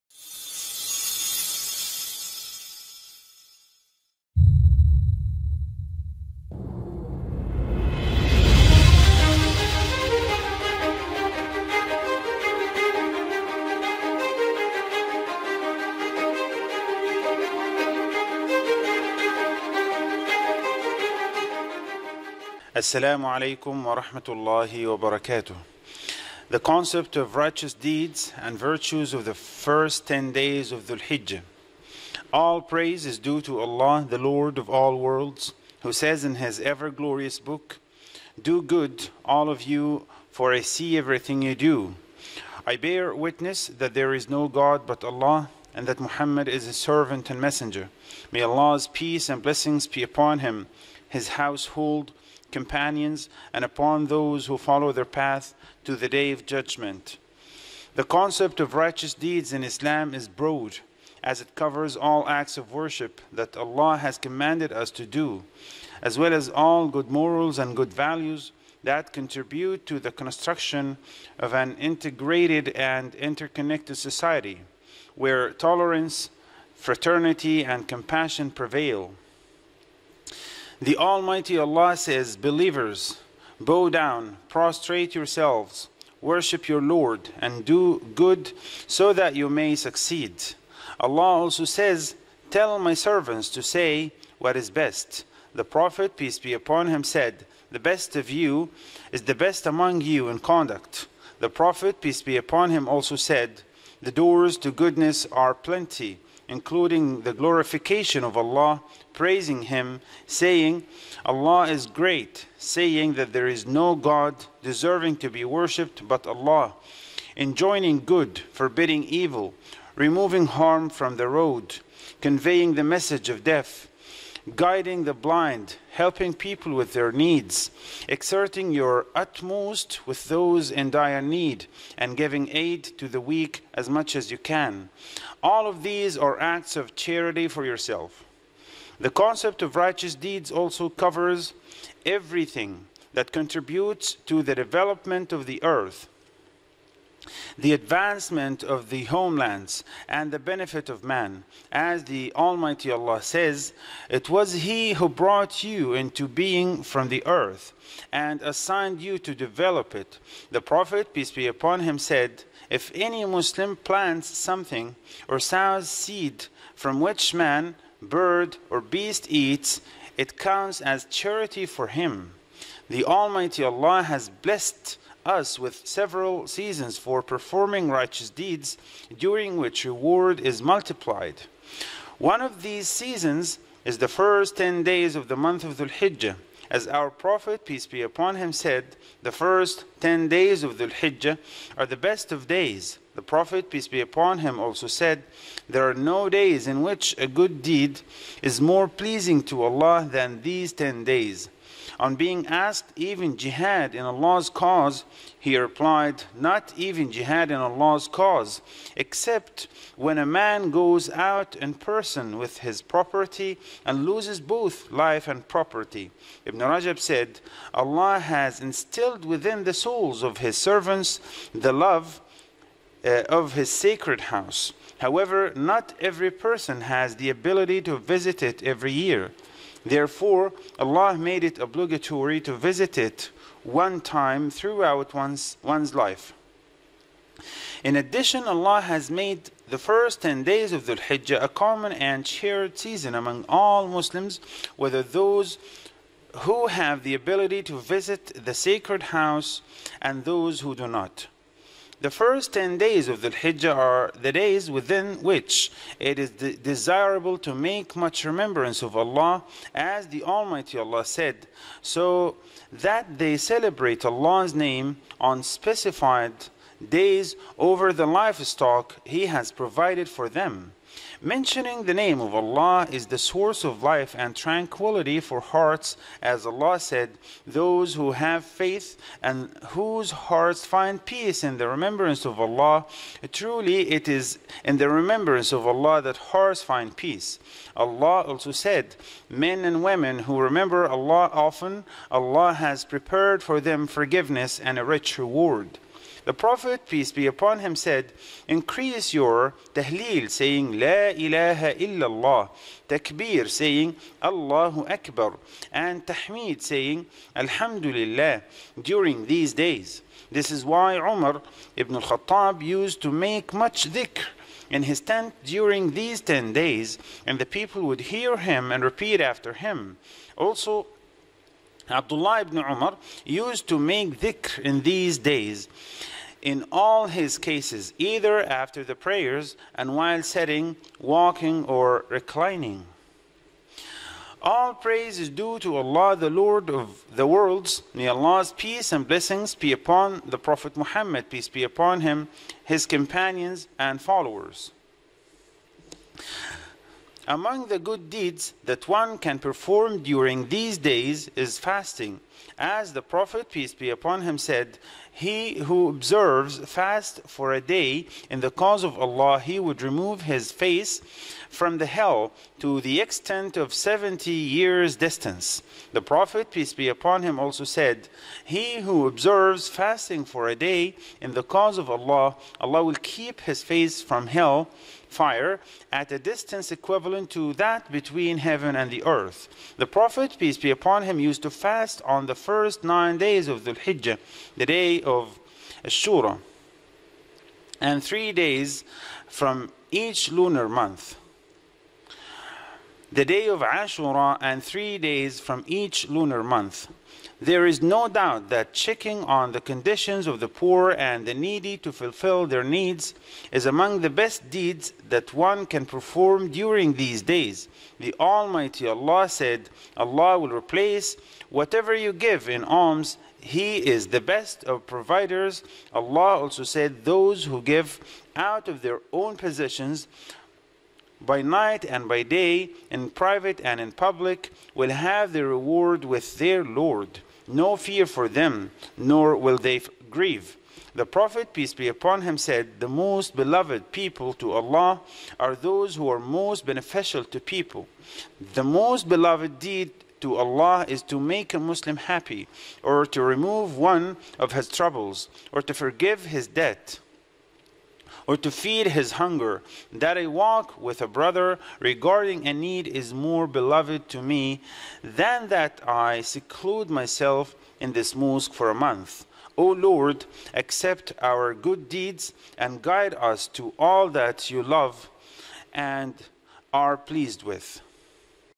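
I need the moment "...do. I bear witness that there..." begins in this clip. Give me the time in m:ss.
0:41.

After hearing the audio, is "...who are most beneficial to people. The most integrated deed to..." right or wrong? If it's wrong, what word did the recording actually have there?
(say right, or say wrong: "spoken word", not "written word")
wrong: "beloved", not "integrated".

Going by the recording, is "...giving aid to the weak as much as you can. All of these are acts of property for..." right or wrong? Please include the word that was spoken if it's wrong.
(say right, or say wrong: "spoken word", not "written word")
wrong: "charity", not "property".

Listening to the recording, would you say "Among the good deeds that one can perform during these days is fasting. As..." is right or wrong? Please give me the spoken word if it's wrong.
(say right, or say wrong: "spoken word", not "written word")
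right.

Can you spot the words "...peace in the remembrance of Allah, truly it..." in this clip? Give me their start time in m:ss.
4:41.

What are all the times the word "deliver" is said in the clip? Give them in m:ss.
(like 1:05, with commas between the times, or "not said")
not said.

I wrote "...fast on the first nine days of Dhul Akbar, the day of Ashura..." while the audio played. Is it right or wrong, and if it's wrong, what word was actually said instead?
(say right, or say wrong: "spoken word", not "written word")
wrong: "Hijjah", not "Akbar".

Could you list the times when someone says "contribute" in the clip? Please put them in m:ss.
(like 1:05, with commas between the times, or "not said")
1:09, 2:23.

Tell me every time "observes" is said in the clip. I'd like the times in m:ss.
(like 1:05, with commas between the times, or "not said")
5:55, 6:09.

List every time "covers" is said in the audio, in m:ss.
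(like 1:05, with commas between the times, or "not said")
1:01, 2:20.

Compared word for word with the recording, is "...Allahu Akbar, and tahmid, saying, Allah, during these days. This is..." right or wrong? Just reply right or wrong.
wrong.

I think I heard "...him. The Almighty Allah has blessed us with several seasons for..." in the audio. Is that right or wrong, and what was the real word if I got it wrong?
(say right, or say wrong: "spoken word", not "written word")
right.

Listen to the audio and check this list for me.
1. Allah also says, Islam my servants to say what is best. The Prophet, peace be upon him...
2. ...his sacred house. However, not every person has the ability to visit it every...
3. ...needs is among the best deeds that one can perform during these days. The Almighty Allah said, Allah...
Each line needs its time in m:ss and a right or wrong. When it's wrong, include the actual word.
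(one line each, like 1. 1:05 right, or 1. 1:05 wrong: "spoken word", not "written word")
1. 1:30 wrong: "Tell", not "Islam"
2. 3:43 right
3. 6:42 right.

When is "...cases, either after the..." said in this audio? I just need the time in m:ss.
5:27.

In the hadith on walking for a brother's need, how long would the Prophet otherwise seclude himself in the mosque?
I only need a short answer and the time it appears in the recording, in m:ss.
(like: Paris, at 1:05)
A month, at 7:38.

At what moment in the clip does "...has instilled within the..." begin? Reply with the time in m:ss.
3:38.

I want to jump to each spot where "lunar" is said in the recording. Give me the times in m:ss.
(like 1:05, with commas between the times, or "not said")
6:30, 6:36.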